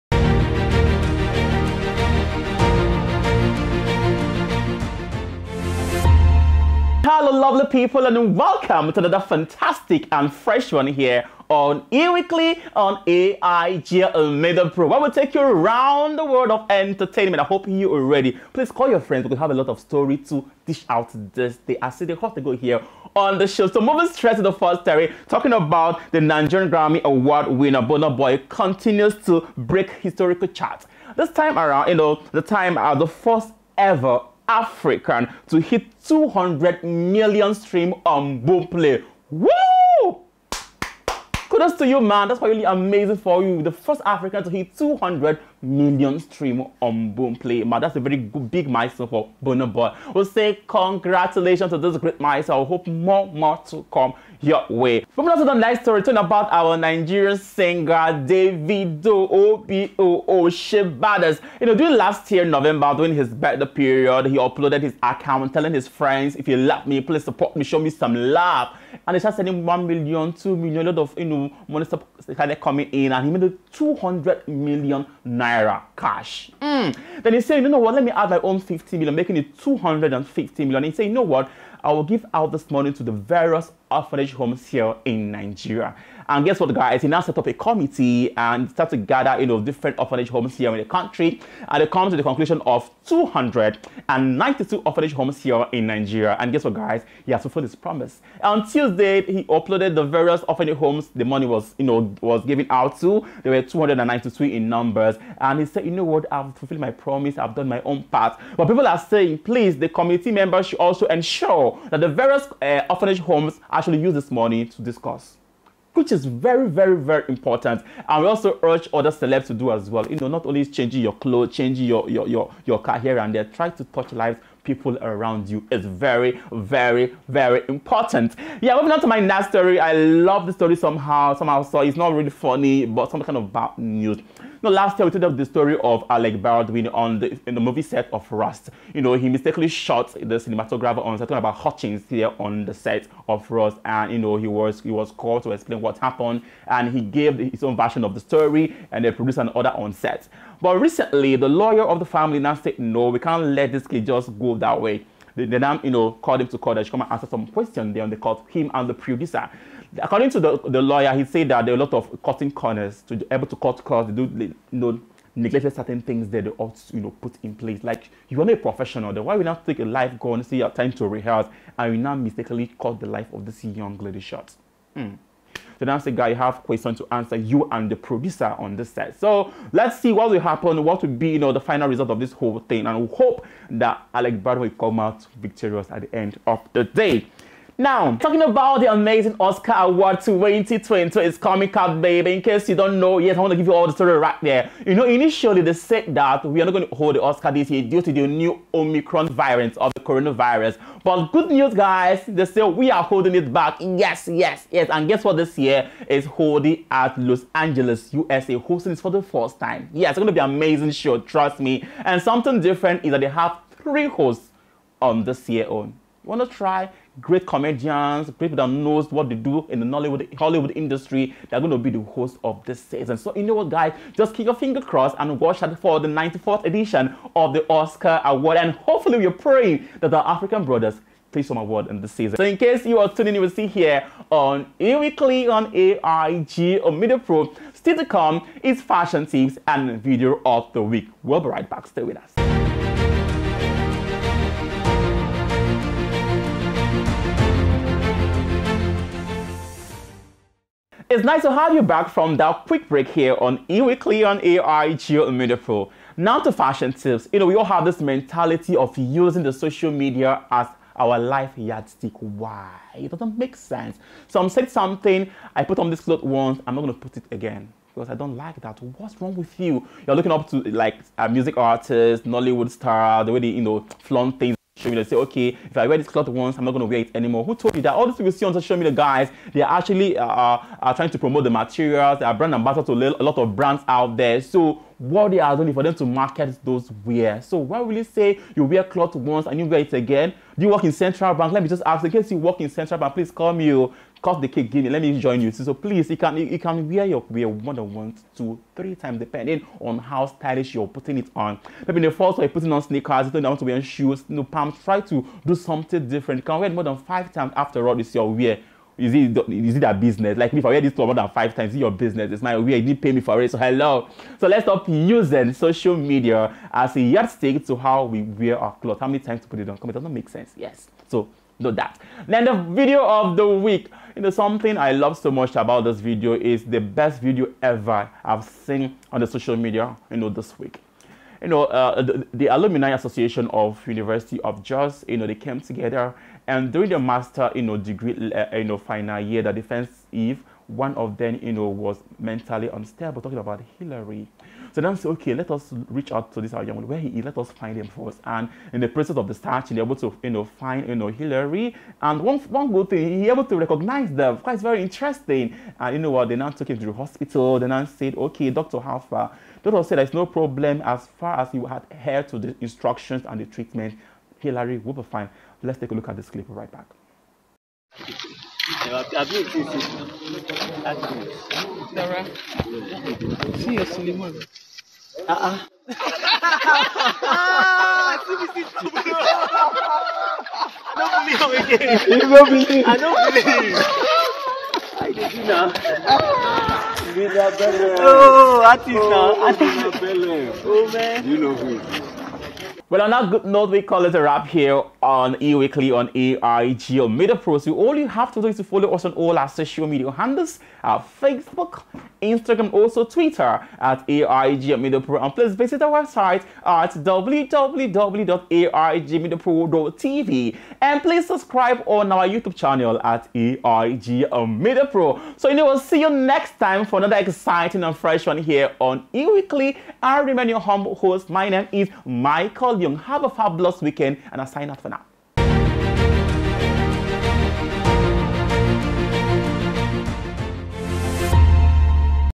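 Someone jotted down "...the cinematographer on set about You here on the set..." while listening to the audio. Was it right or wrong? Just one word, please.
wrong.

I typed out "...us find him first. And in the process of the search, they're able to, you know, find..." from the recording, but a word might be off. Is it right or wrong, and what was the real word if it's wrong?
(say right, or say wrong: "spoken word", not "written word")
right.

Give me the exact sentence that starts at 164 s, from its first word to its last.
They do, you know, neglected certain things that they ought to, you know, put in place.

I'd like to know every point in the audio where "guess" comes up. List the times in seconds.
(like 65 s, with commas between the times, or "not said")
86 s, 96 s, 205 s.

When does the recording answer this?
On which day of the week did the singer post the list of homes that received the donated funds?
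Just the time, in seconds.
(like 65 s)
98 s.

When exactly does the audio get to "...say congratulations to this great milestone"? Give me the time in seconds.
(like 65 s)
50 s.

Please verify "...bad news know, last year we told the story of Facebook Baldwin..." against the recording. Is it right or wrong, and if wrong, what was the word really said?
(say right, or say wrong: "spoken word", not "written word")
wrong: "Alec", not "Facebook".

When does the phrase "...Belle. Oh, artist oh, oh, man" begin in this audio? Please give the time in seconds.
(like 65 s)
387 s.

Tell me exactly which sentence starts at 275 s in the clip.
Say, okay, if I wear this cloth once, I'm not going to wear it anymore.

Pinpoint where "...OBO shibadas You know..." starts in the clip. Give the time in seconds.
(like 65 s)
59 s.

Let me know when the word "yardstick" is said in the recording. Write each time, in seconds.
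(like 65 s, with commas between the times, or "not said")
261 s, 317 s.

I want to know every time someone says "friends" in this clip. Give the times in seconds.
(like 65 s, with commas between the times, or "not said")
18 s, 65 s.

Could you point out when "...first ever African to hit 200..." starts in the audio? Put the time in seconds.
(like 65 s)
33 s.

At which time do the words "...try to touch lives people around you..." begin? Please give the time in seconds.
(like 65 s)
123 s.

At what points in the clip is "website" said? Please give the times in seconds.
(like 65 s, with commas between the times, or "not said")
406 s.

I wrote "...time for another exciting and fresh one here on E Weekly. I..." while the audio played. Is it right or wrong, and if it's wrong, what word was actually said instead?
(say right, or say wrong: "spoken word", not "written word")
right.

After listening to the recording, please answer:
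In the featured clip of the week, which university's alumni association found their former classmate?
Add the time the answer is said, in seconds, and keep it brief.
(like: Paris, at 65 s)
University of Jos, at 333 s.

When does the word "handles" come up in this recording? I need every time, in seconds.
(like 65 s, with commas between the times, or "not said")
400 s.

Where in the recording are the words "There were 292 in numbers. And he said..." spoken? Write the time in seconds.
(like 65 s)
103 s.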